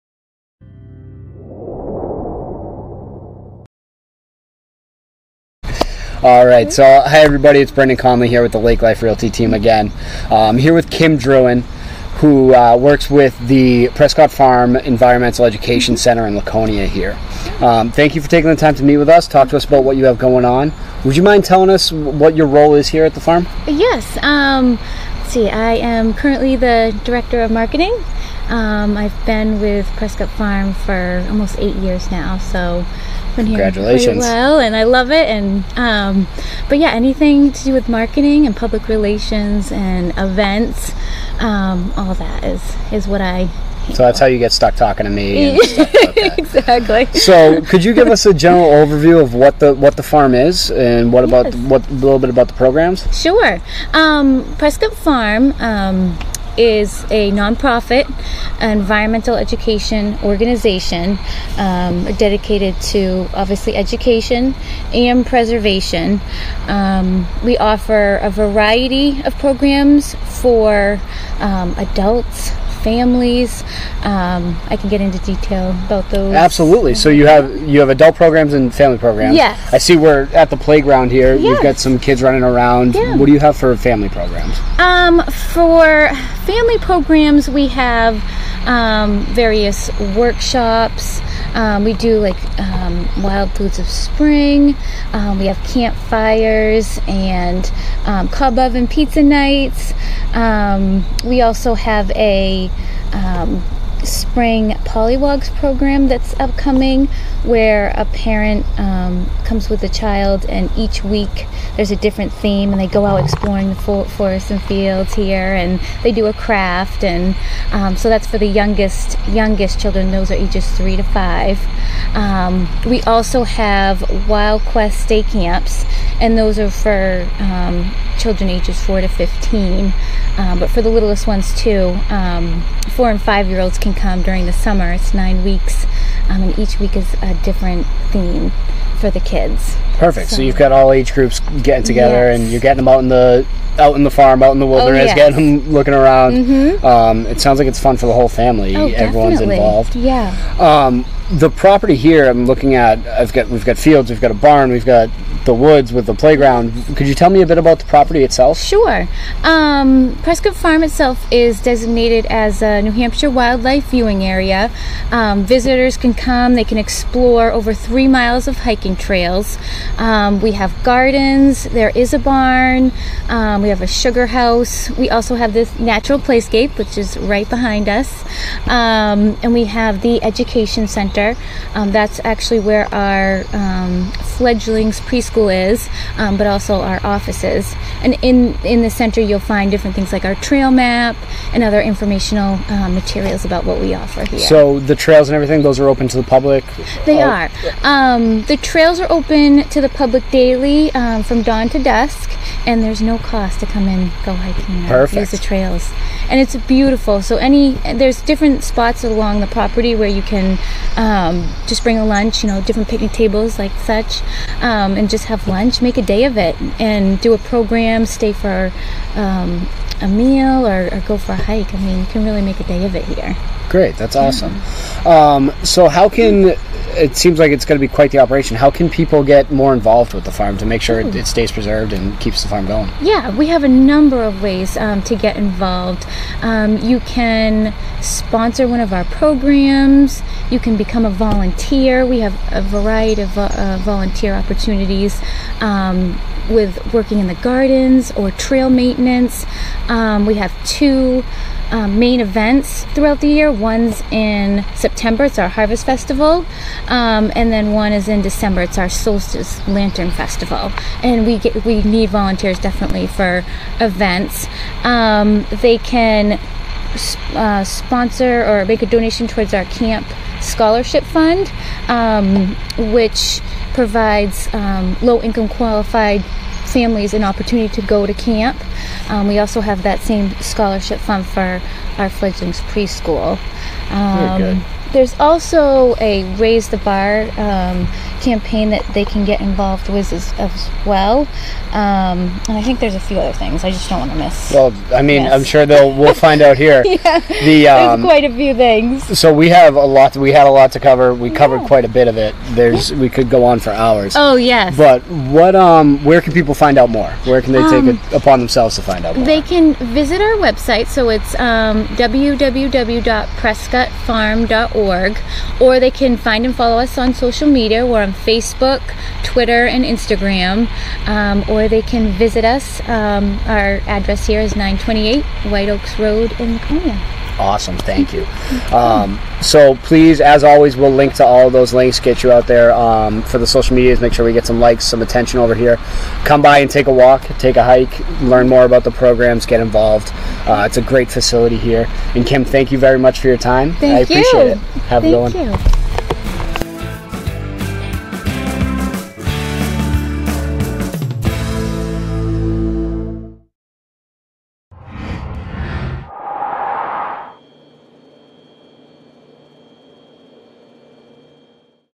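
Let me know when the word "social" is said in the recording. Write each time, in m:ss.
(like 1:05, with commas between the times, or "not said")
5:17, 5:33.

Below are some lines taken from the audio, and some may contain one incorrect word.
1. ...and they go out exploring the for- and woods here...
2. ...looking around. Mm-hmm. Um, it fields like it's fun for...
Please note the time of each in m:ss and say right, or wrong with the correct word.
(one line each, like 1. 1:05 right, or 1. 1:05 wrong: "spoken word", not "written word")
1. 1:52 wrong: "fields", not "woods"
2. 2:25 wrong: "sounds", not "fields".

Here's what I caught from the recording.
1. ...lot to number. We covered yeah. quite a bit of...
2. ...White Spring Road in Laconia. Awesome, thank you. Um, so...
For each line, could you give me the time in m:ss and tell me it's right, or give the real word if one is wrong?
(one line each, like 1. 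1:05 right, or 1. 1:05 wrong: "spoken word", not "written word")
1. 5:00 wrong: "cover", not "number"
2. 5:25 wrong: "Oaks", not "Spring".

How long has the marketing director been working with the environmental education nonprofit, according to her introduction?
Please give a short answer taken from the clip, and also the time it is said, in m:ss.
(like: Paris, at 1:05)
almost 8 years, at 0:31.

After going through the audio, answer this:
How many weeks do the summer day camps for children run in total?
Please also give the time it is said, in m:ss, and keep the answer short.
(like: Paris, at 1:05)
9, at 2:15.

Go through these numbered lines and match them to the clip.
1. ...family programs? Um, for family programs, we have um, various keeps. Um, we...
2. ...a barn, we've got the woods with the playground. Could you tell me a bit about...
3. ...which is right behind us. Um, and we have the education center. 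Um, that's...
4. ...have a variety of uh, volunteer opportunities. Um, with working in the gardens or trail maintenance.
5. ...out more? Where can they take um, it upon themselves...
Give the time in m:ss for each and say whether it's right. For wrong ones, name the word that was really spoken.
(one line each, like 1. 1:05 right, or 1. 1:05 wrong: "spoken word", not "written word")
1. 1:23 wrong: "workshops", not "keeps"
2. 2:34 right
3. 2:56 right
4. 4:02 right
5. 5:06 right.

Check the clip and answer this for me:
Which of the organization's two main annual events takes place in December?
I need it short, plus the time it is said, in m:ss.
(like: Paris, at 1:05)
Solstice Lantern Festival, at 4:18.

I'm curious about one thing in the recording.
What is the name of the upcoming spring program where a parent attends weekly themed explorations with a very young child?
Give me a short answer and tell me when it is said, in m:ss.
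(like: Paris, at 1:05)
Polywogs, at 1:44.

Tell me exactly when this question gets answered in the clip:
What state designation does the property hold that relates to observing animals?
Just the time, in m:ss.
2:42.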